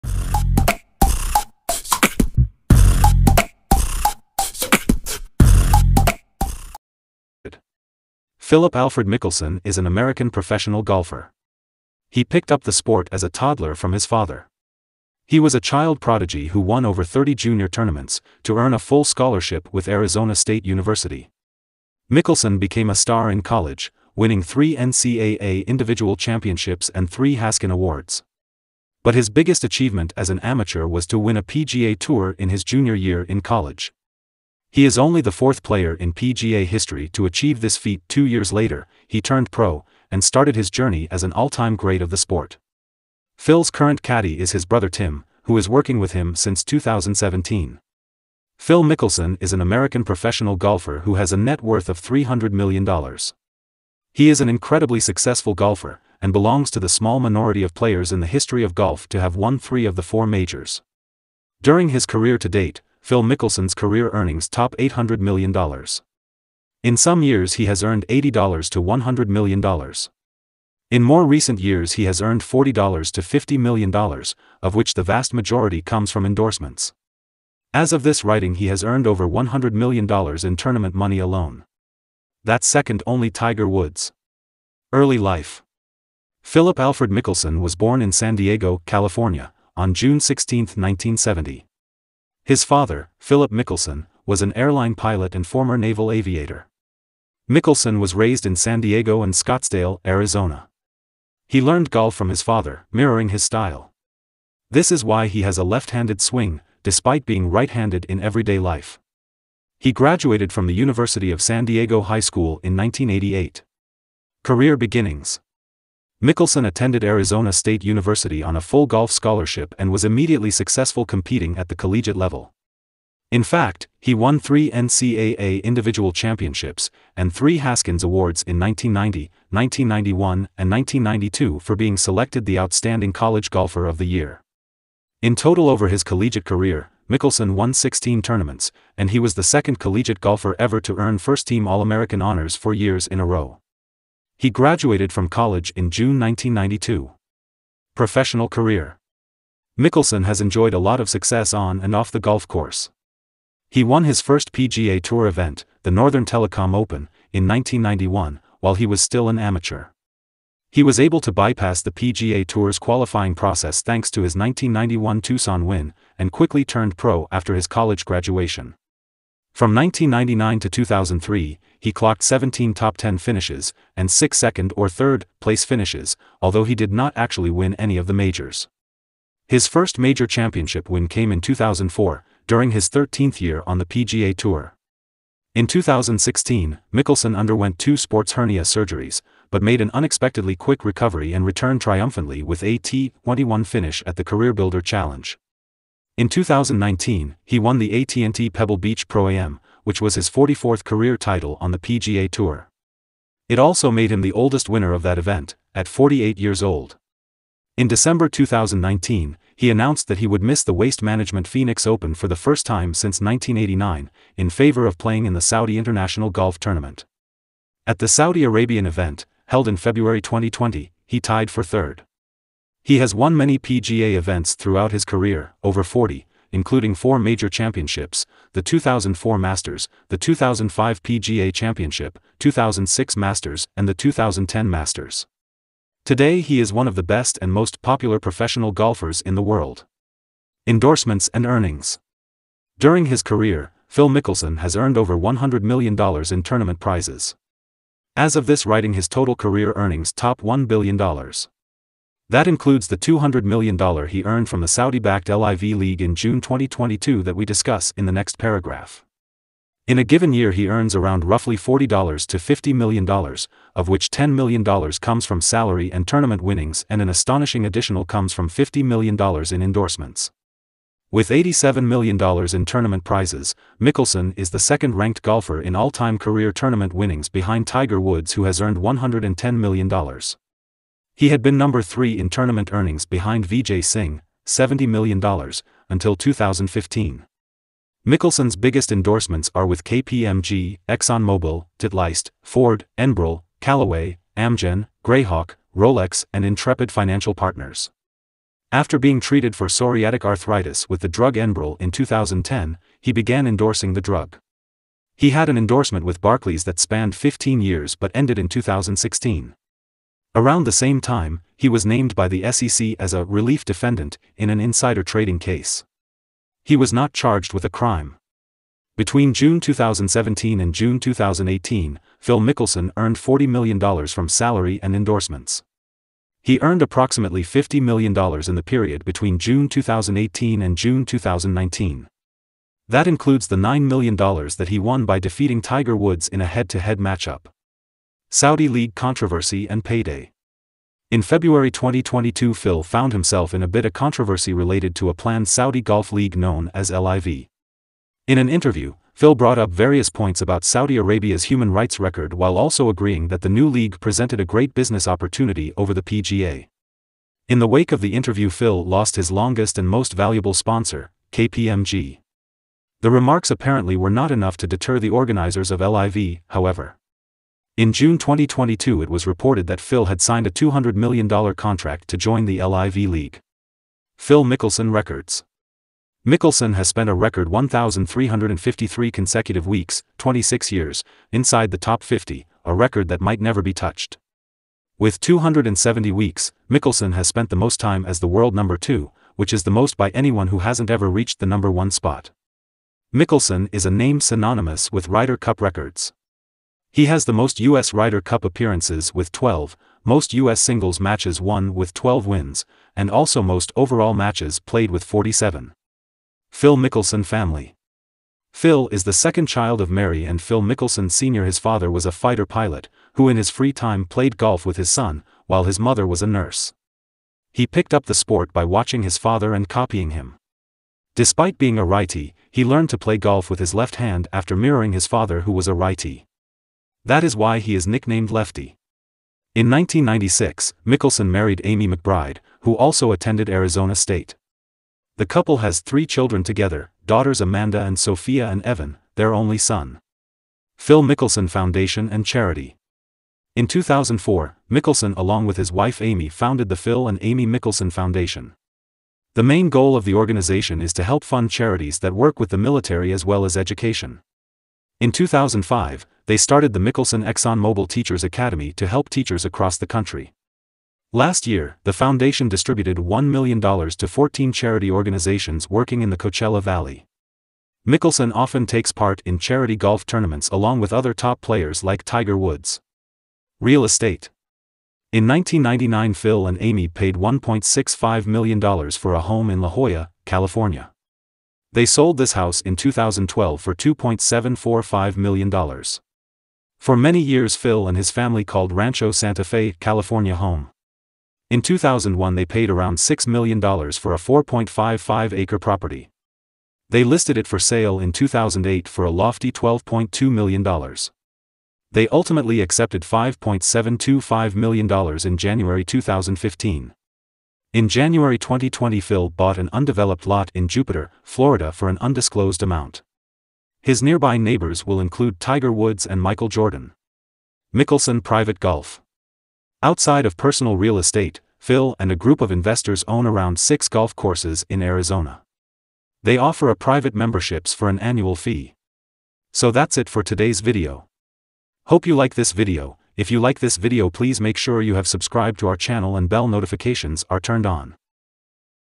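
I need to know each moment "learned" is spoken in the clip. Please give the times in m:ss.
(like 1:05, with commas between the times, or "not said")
1:41, 7:02.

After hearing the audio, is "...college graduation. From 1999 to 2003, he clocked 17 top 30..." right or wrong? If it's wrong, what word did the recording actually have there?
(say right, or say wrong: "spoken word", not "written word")
wrong: "10", not "30".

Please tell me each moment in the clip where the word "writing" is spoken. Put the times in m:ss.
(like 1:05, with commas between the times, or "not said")
1:18, 4:08.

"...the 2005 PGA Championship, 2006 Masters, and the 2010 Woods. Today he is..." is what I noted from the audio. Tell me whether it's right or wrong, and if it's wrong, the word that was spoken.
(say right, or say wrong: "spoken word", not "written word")
wrong: "Masters", not "Woods".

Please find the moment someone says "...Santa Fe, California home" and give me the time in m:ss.
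8:09.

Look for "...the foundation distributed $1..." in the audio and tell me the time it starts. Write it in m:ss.
7:41.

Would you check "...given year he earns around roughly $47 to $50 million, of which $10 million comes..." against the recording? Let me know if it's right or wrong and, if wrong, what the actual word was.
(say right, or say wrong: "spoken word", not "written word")
wrong: "40", not "47".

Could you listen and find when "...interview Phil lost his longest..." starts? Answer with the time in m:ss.
5:58.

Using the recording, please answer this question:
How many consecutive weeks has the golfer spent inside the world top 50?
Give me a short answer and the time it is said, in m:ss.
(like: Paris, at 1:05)
1,353, at 6:17.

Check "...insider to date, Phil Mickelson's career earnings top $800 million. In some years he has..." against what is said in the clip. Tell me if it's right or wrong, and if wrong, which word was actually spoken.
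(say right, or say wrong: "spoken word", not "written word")
wrong: "career", not "insider".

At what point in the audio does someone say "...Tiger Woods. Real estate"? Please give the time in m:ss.
7:52.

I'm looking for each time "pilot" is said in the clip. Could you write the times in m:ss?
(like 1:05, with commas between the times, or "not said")
1:34, 6:52.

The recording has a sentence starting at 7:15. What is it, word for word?
The couple has three children together, daughters Amanda and Sophia and Evan, their only son.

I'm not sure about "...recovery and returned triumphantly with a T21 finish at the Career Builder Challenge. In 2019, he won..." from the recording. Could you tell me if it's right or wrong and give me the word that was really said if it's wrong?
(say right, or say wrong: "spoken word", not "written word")
right.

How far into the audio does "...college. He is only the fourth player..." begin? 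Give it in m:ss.
0:33.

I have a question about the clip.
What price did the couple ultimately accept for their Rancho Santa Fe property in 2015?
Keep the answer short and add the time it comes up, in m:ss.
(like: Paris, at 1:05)
$5.725 million, at 8:23.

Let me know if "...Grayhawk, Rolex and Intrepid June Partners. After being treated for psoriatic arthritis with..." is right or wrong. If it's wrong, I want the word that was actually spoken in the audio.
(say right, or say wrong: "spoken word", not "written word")
wrong: "Financial", not "June".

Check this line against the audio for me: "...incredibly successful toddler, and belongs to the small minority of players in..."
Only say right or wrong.
wrong.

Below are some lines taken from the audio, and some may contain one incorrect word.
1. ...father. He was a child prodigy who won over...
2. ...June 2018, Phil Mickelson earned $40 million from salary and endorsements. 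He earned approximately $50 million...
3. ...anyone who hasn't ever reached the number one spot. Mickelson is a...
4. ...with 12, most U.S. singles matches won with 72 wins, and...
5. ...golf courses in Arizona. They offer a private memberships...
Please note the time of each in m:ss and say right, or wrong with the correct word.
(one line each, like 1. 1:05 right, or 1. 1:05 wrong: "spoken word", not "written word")
1. 0:14 right
2. 5:20 right
3. 6:30 right
4. 6:39 wrong: "12", not "72"
5. 8:43 right.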